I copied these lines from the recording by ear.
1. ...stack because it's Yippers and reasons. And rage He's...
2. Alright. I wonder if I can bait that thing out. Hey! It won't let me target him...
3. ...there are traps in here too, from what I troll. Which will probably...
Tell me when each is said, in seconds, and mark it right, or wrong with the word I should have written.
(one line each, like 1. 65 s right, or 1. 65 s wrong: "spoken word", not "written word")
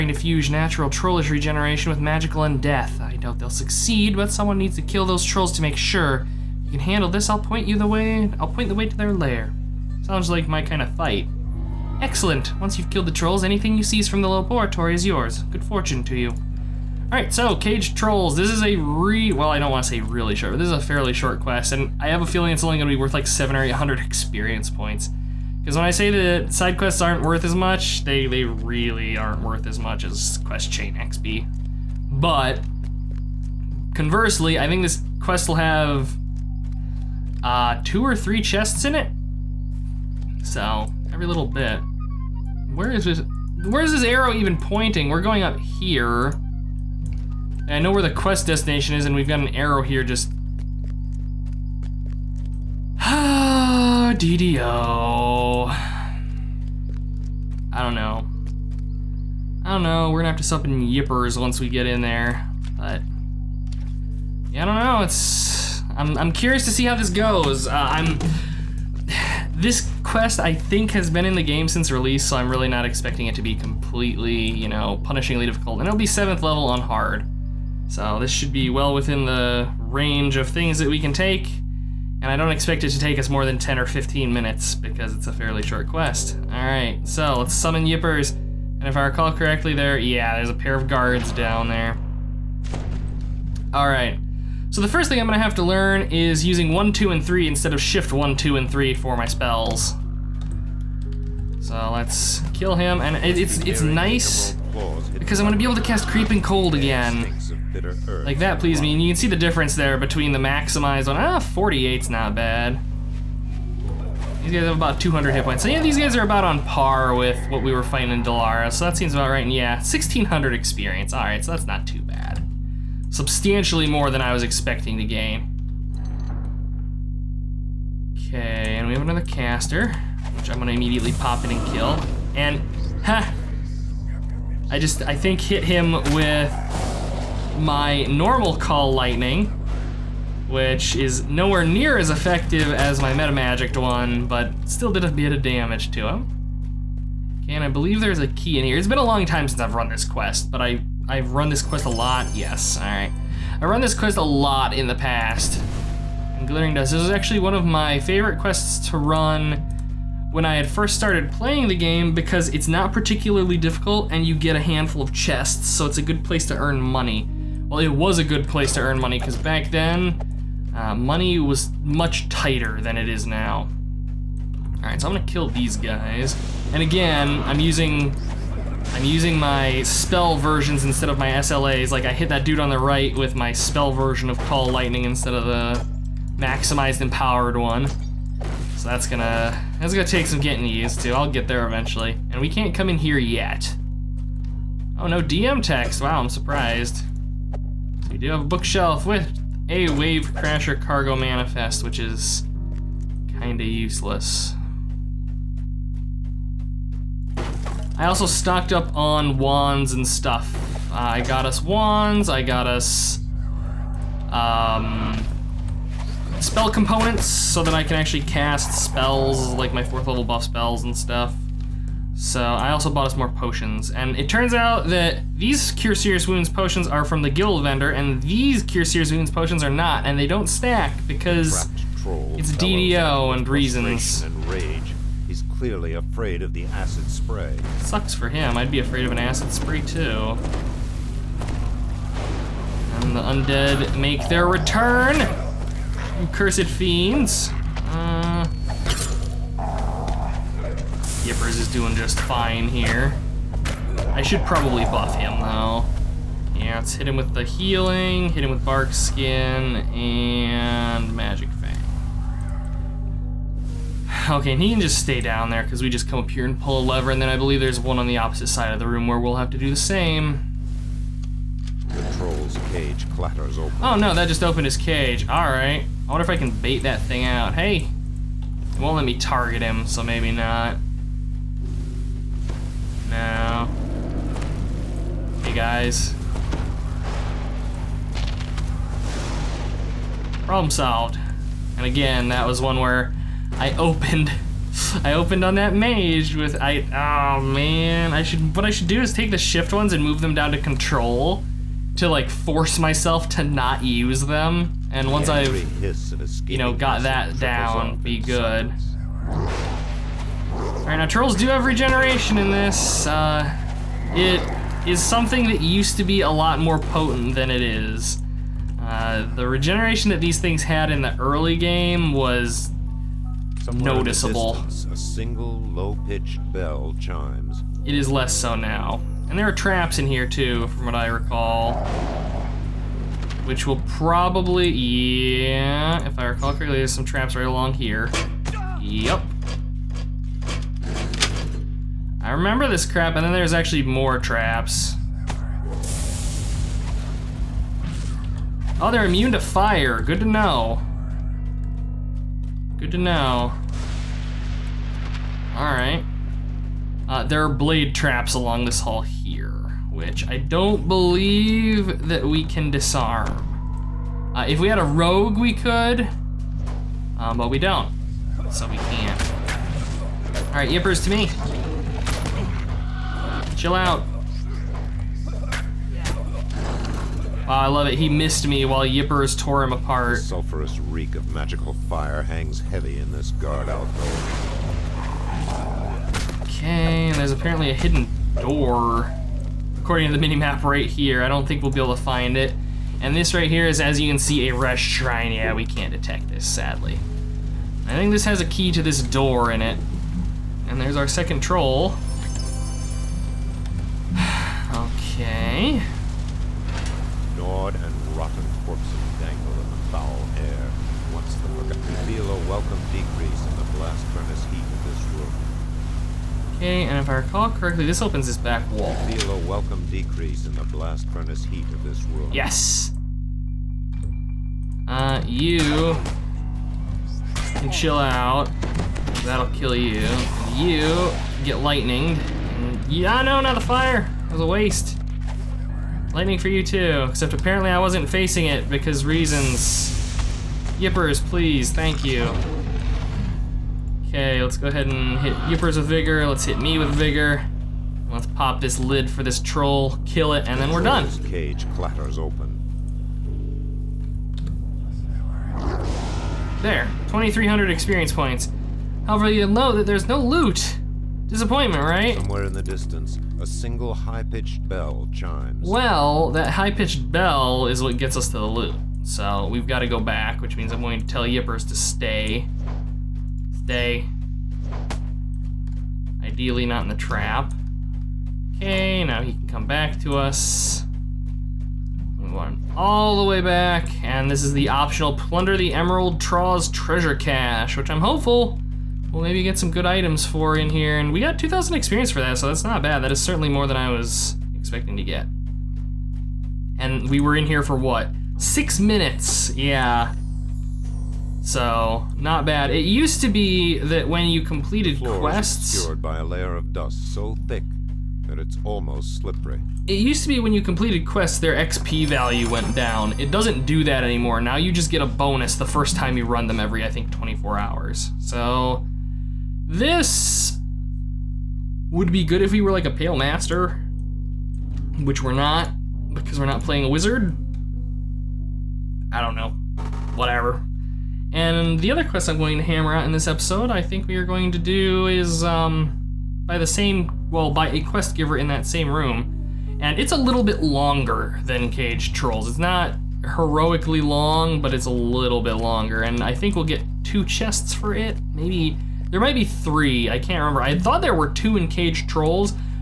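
1. 230 s wrong: "DDO", not "Yippers"
2. 275 s right
3. 329 s wrong: "recall", not "troll".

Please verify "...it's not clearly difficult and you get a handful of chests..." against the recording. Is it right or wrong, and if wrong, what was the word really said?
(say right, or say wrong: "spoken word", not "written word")
wrong: "particularly", not "clearly".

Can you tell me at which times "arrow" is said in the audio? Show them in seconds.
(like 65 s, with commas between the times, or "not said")
44 s, 49 s.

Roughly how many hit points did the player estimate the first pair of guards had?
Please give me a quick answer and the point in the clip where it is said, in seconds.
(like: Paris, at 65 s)
200, at 115 s.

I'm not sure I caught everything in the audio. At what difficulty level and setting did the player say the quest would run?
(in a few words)
7th level on hard.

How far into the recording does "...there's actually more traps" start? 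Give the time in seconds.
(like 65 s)
343 s.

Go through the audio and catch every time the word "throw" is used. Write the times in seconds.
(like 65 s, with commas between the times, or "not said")
not said.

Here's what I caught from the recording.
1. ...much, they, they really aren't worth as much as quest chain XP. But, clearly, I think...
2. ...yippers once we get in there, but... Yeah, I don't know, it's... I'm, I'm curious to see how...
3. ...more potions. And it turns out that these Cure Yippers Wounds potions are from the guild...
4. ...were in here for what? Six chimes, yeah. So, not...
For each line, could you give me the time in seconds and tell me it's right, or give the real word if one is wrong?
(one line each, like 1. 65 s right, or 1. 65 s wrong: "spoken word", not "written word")
1. 27 s wrong: "conversely", not "clearly"
2. 60 s right
3. 223 s wrong: "Serious", not "Yippers"
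4. 497 s wrong: "minutes", not "chimes".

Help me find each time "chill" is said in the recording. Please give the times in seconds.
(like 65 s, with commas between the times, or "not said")
373 s, 427 s.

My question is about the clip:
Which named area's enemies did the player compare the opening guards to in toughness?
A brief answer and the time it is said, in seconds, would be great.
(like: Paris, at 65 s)
Delera, at 118 s.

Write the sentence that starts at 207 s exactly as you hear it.
I also stocked up on wands and stuff.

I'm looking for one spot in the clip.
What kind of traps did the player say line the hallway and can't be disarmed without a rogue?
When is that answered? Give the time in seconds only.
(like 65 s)
357 s.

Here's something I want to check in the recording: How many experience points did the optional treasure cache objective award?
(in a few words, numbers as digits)
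2,000.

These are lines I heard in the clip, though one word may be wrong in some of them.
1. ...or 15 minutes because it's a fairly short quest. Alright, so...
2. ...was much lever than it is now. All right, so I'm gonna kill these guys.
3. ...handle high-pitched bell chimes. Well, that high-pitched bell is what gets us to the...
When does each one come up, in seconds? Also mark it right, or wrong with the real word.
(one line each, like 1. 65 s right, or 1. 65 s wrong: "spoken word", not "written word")
1. 83 s right
2. 171 s wrong: "tighter", not "lever"
3. 463 s wrong: "single", not "handle".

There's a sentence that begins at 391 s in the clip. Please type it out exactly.
I don't think we'll be able to find it.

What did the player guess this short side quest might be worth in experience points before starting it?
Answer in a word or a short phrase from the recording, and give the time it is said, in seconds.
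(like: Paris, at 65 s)
700 or 800, at 23 s.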